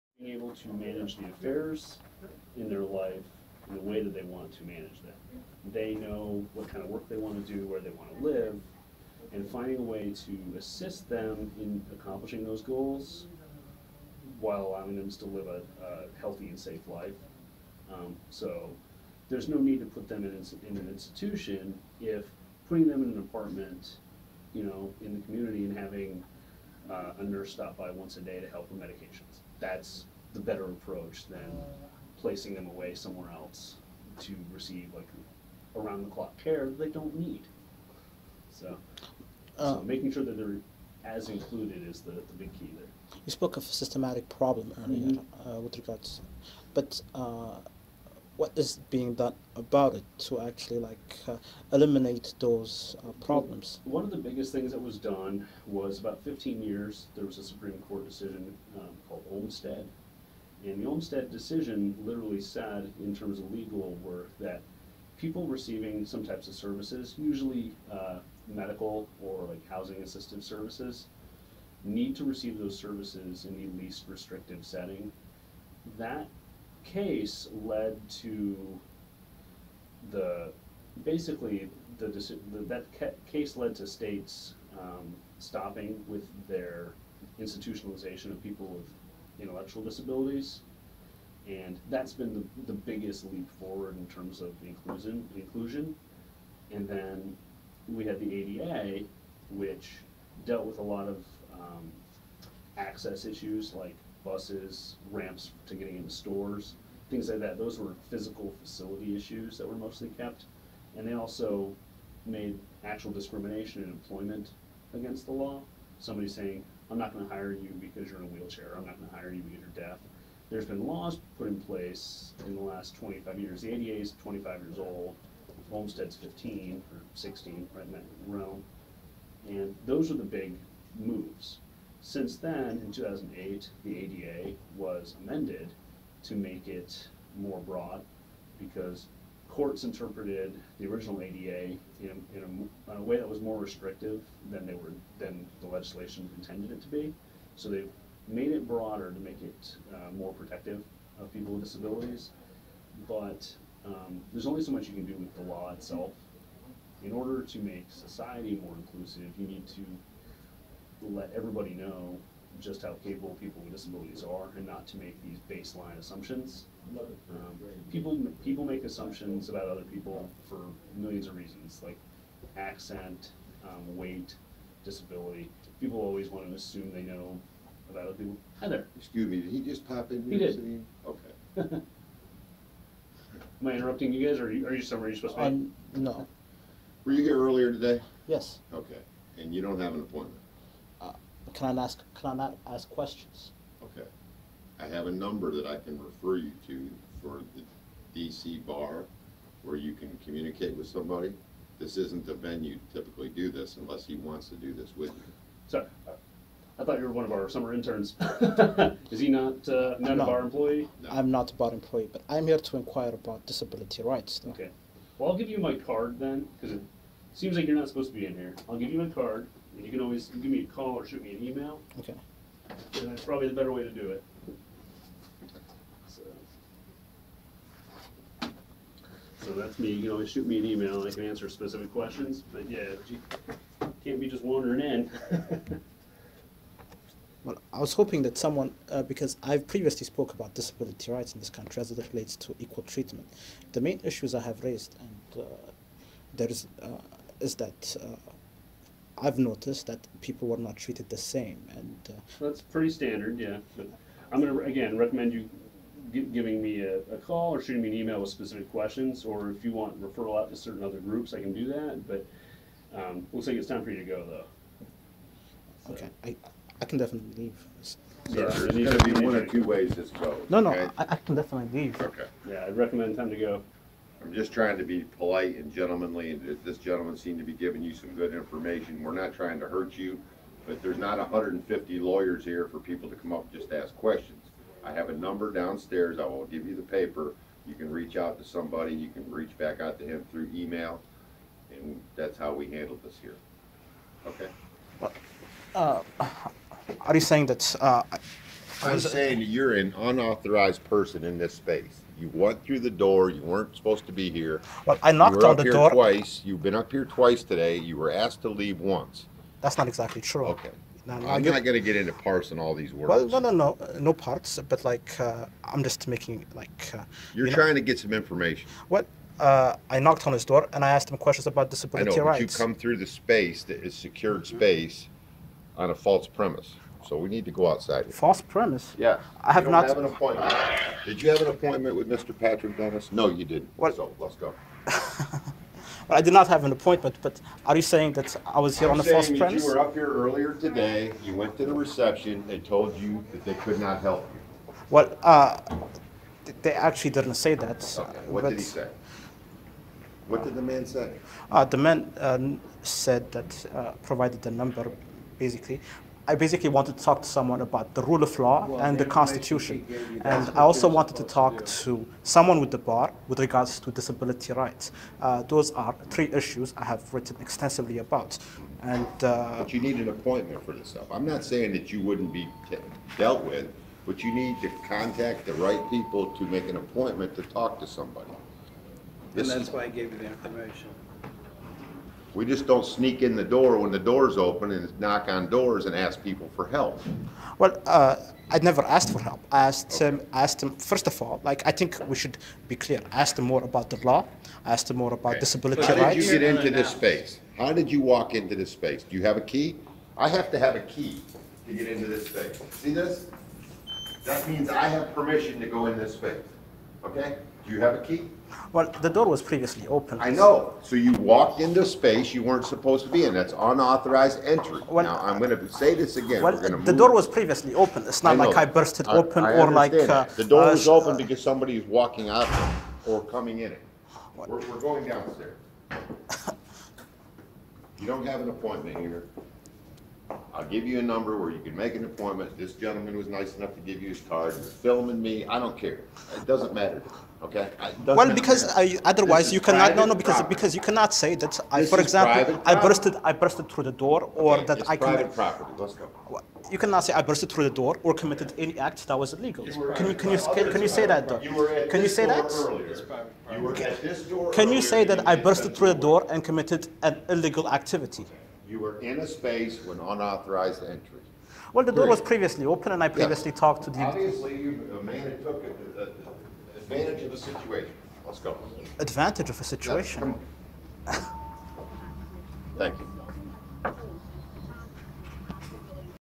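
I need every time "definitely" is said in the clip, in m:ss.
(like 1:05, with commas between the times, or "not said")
4:26, 4:31.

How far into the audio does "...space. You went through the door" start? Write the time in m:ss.
5:01.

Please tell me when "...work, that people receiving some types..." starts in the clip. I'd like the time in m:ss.
1:04.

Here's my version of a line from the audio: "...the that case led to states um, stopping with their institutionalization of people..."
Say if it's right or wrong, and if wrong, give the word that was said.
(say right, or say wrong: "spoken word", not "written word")
right.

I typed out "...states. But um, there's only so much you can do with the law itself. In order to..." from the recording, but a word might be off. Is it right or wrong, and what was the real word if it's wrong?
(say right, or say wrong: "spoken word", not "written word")
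wrong: "disabilities", not "states".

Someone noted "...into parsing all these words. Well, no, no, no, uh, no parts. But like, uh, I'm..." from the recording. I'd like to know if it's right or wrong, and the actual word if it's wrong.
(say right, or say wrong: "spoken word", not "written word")
right.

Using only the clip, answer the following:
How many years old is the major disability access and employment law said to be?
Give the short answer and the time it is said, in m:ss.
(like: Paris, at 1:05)
25, at 2:03.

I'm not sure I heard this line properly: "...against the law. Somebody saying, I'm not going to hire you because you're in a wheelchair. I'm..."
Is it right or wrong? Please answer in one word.
right.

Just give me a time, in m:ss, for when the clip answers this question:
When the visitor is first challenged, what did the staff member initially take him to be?
3:27.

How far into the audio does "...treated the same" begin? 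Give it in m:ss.
4:10.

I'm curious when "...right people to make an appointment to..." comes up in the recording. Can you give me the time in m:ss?
6:15.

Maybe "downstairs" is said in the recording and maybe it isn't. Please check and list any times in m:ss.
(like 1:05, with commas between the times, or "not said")
4:45, 7:05.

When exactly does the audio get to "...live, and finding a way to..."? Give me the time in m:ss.
0:08.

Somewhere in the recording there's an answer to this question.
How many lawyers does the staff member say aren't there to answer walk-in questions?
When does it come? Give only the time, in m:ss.
4:41.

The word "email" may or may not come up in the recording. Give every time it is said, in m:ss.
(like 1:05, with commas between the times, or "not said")
3:41, 3:50, 4:17, 4:50.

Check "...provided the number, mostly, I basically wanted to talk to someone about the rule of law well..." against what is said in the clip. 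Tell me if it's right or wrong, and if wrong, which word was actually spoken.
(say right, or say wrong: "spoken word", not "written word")
wrong: "basically", not "mostly".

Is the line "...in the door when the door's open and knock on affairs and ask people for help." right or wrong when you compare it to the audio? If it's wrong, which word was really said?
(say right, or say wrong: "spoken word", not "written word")
wrong: "doors", not "affairs".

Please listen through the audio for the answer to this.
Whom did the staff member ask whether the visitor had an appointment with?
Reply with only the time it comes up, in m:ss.
5:32.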